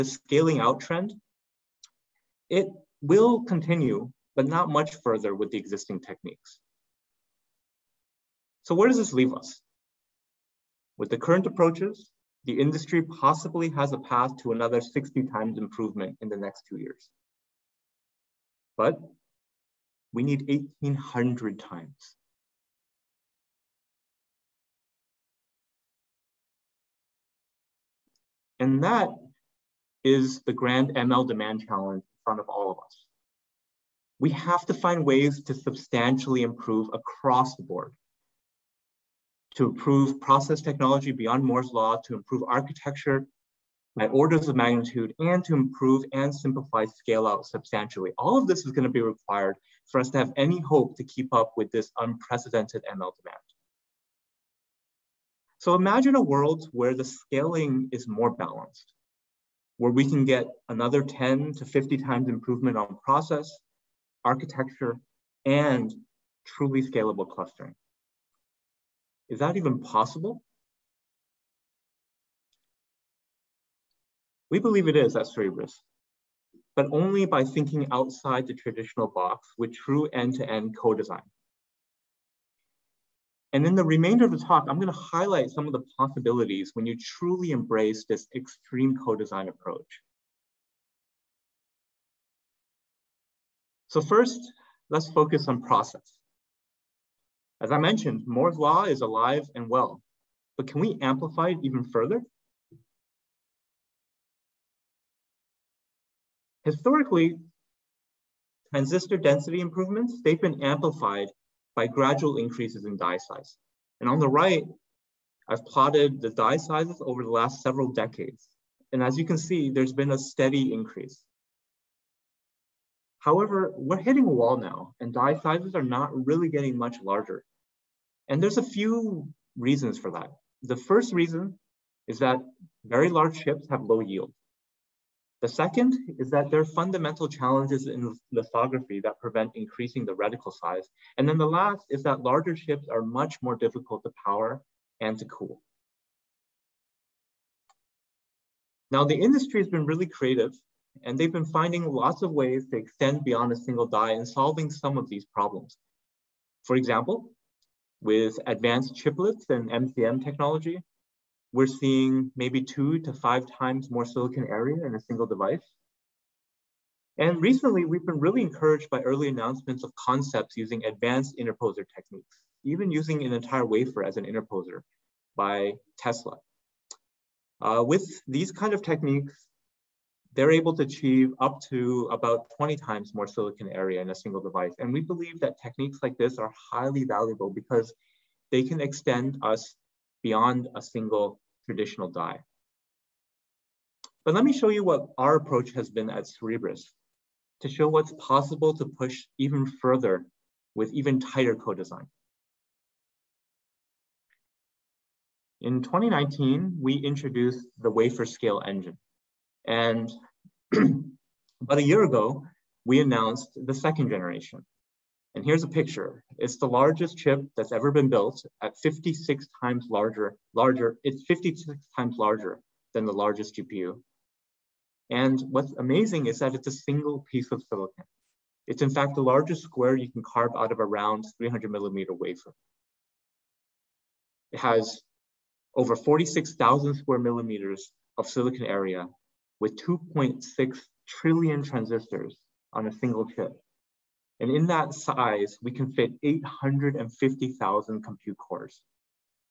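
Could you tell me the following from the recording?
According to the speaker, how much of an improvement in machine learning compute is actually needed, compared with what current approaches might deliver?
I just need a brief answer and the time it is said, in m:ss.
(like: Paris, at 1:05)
1,800 times, at 0:20.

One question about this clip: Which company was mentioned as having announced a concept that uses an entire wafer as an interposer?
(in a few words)
Tesla.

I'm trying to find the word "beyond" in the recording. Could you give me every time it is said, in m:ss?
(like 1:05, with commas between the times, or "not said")
0:41, 2:33, 3:10.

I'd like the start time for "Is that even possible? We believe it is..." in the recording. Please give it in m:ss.
1:09.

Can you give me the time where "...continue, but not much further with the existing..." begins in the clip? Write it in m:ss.
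0:03.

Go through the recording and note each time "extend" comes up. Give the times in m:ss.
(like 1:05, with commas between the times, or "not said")
2:32, 3:08.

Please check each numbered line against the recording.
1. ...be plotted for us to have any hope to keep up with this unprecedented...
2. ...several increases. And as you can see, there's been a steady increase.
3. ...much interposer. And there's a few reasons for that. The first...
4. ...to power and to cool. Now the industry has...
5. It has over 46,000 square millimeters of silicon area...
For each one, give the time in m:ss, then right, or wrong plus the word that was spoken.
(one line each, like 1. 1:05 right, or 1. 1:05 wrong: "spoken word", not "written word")
1. 0:48 wrong: "required", not "plotted"
2. 1:57 wrong: "decades", not "increases"
3. 2:06 wrong: "larger", not "interposer"
4. 2:24 right
5. 3:54 right.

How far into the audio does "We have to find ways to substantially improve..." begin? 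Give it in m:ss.
0:34.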